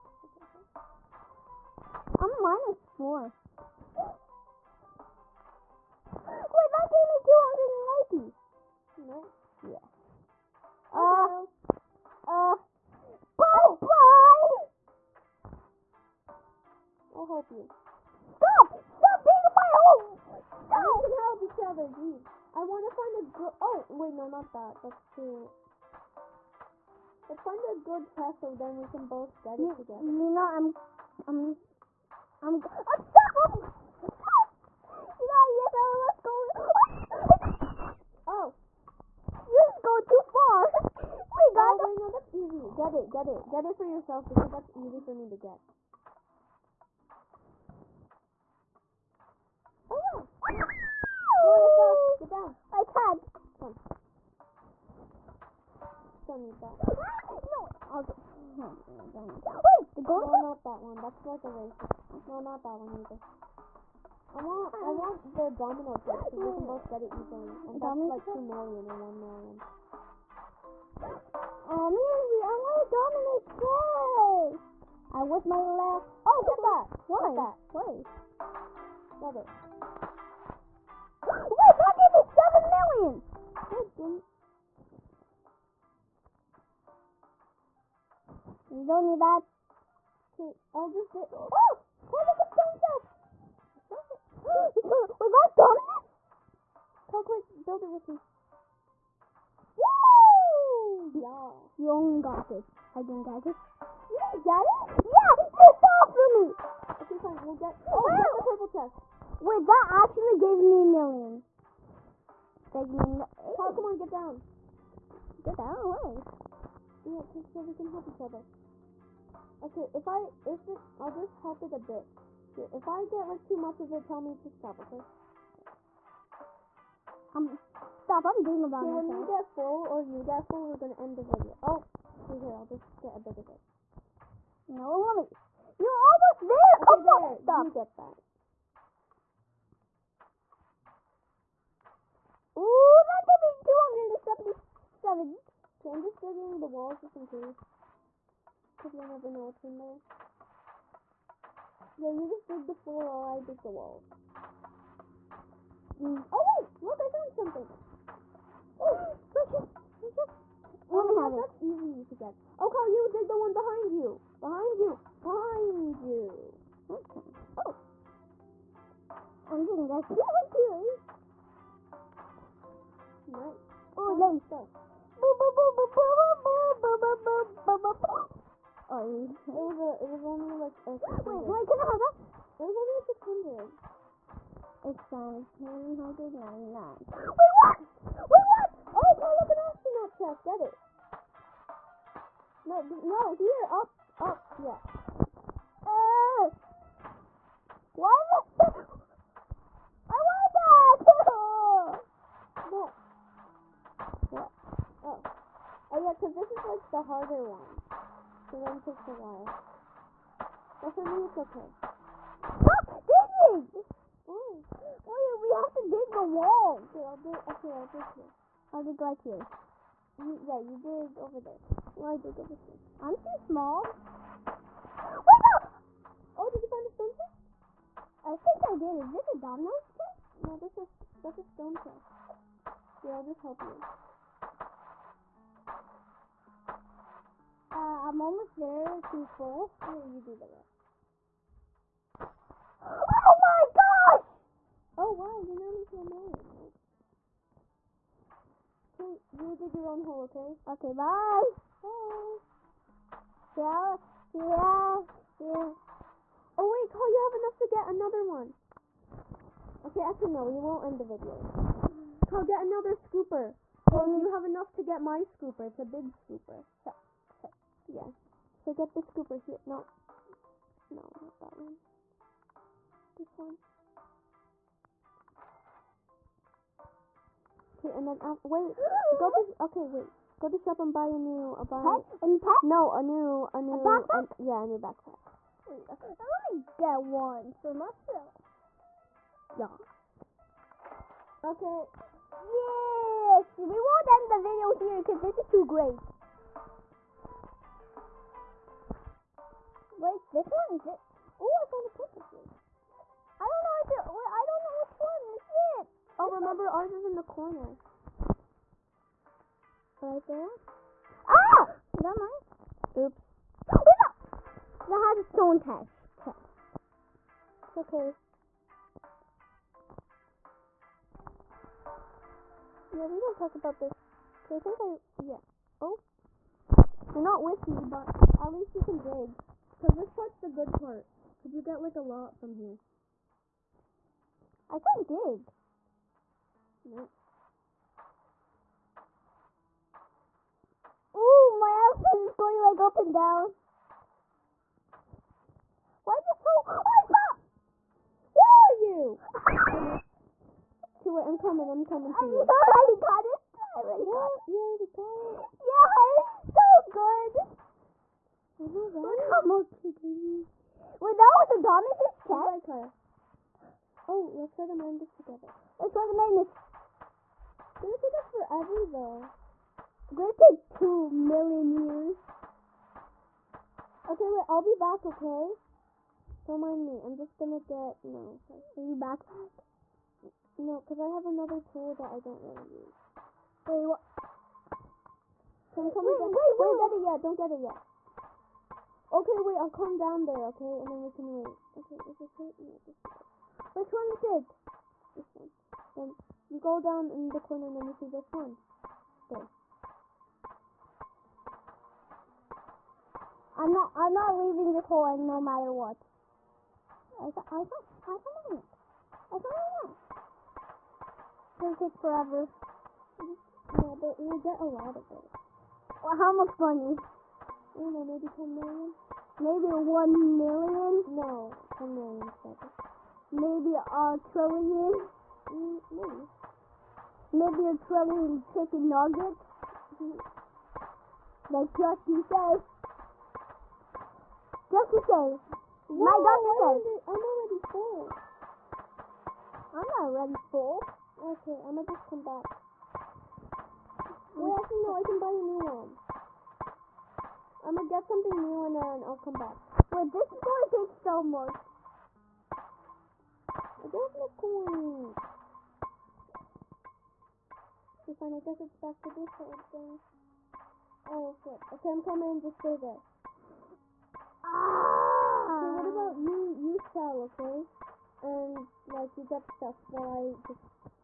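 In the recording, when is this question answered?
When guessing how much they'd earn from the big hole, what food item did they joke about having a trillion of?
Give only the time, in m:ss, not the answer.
7:08.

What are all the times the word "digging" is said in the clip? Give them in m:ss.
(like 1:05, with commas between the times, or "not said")
2:26, 3:32.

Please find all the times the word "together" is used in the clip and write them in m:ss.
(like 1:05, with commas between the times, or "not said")
0:29, 6:05.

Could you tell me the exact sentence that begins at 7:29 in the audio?
Wait, this is gonna take so much.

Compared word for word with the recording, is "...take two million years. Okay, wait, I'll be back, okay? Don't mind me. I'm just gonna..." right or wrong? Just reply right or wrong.
right.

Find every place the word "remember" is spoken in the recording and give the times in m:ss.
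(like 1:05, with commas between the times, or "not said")
5:06.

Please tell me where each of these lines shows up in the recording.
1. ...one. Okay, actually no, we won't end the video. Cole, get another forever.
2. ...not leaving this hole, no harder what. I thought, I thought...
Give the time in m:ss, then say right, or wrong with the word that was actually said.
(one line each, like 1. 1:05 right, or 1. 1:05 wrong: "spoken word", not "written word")
1. 4:18 wrong: "scooper", not "forever"
2. 6:44 wrong: "matter", not "harder".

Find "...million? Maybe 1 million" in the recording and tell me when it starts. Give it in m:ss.
6:58.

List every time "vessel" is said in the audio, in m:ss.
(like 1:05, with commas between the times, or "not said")
0:28.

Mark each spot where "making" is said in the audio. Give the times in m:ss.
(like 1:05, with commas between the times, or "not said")
not said.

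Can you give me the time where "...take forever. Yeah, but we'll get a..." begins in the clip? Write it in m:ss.
6:51.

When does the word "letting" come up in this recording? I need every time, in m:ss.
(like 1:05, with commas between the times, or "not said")
not said.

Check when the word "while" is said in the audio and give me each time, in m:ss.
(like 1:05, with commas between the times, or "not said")
2:32, 3:29, 7:49.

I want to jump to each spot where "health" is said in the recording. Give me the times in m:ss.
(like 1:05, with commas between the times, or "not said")
not said.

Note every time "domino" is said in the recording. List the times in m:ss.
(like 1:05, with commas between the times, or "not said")
1:05, 1:13, 3:49.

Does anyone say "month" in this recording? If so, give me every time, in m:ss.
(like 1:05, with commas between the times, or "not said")
not said.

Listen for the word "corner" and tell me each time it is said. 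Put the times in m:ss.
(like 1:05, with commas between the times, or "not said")
5:07, 6:37.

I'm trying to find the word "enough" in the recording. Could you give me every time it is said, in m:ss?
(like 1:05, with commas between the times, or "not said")
4:17, 4:24.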